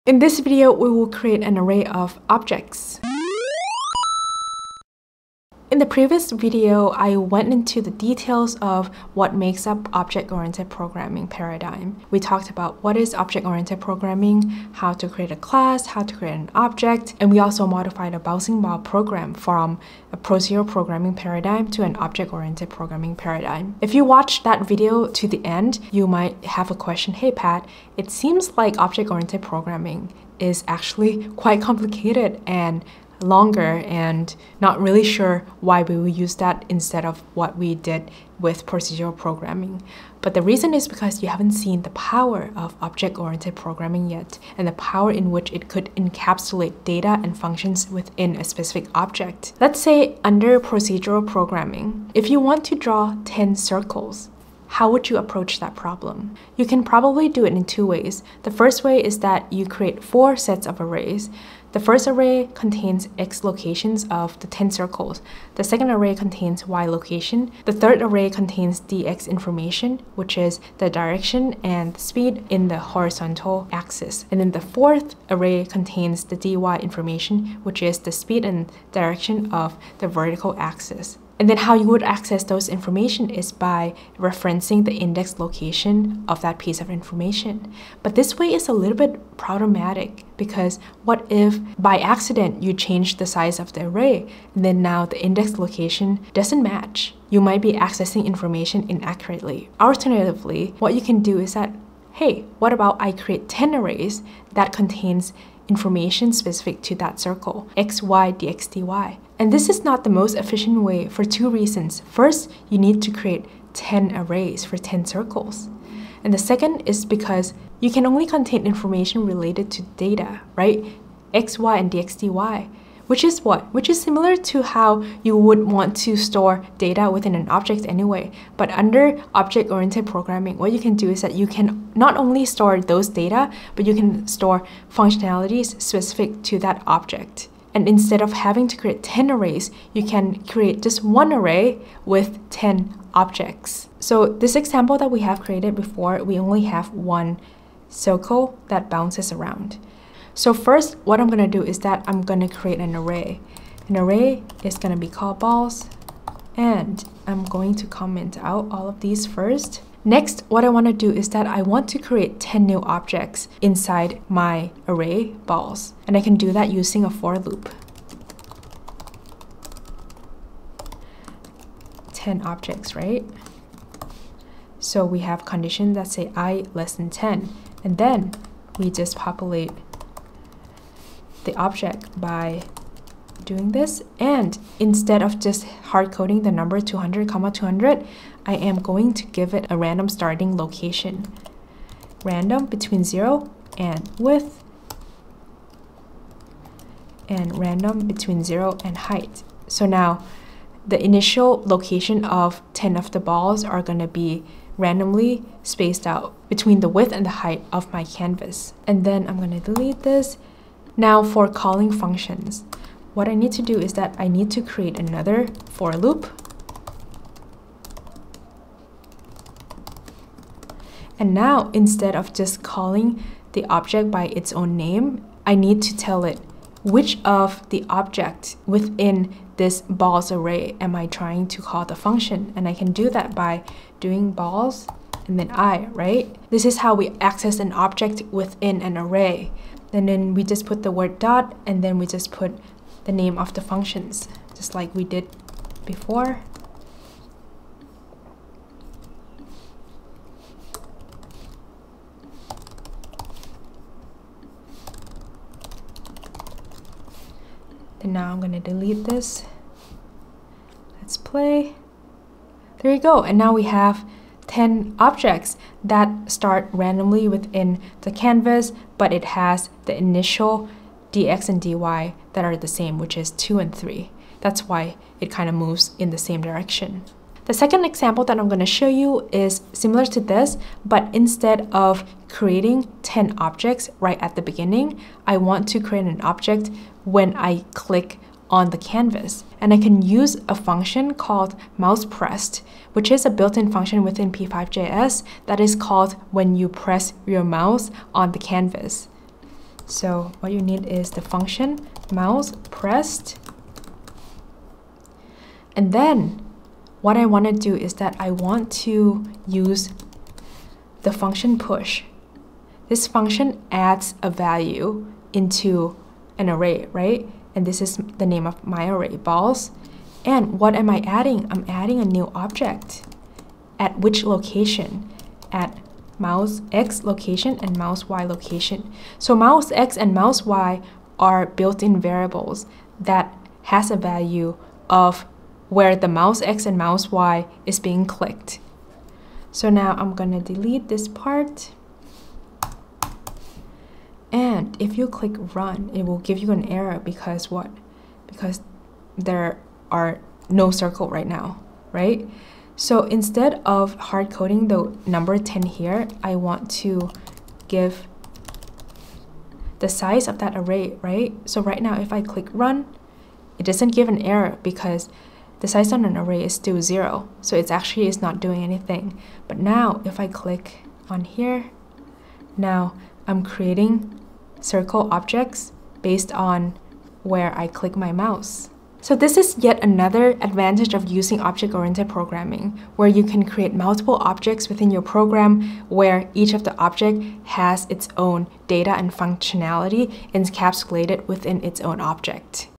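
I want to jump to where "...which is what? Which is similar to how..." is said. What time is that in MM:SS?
02:03.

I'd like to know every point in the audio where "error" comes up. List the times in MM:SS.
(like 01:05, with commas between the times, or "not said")
05:46, 06:04.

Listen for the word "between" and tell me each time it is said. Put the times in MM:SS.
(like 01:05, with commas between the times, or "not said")
03:12, 03:18, 03:26.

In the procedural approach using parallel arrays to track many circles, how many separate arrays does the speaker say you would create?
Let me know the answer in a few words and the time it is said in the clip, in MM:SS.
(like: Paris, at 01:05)
4, at 01:00.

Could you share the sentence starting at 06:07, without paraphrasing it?
So it's actually is not doing anything.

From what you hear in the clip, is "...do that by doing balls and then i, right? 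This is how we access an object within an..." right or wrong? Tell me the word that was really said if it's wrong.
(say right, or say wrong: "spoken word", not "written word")
right.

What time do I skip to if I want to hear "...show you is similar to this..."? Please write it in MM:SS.
04:38.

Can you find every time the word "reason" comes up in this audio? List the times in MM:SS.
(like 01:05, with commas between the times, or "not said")
00:40, 01:51.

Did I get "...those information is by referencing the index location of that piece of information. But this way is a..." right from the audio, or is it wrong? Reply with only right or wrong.
right.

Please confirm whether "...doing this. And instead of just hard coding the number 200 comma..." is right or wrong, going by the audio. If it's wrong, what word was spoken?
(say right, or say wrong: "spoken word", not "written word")
right.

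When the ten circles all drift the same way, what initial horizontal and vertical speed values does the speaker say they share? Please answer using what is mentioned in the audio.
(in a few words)
2 and 3.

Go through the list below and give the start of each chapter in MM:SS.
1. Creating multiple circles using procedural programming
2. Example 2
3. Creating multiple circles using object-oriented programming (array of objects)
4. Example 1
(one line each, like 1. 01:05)
1. 00:50
2. 04:37
3. 02:09
4. 02:24.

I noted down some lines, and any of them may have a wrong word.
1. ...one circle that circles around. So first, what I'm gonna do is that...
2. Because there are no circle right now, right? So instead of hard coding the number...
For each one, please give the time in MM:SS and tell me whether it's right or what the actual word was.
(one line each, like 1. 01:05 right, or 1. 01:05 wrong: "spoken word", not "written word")
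1. 02:26 wrong: "bounces", not "circles"
2. 05:48 right.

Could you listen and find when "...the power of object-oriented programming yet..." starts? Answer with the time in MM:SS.
00:41.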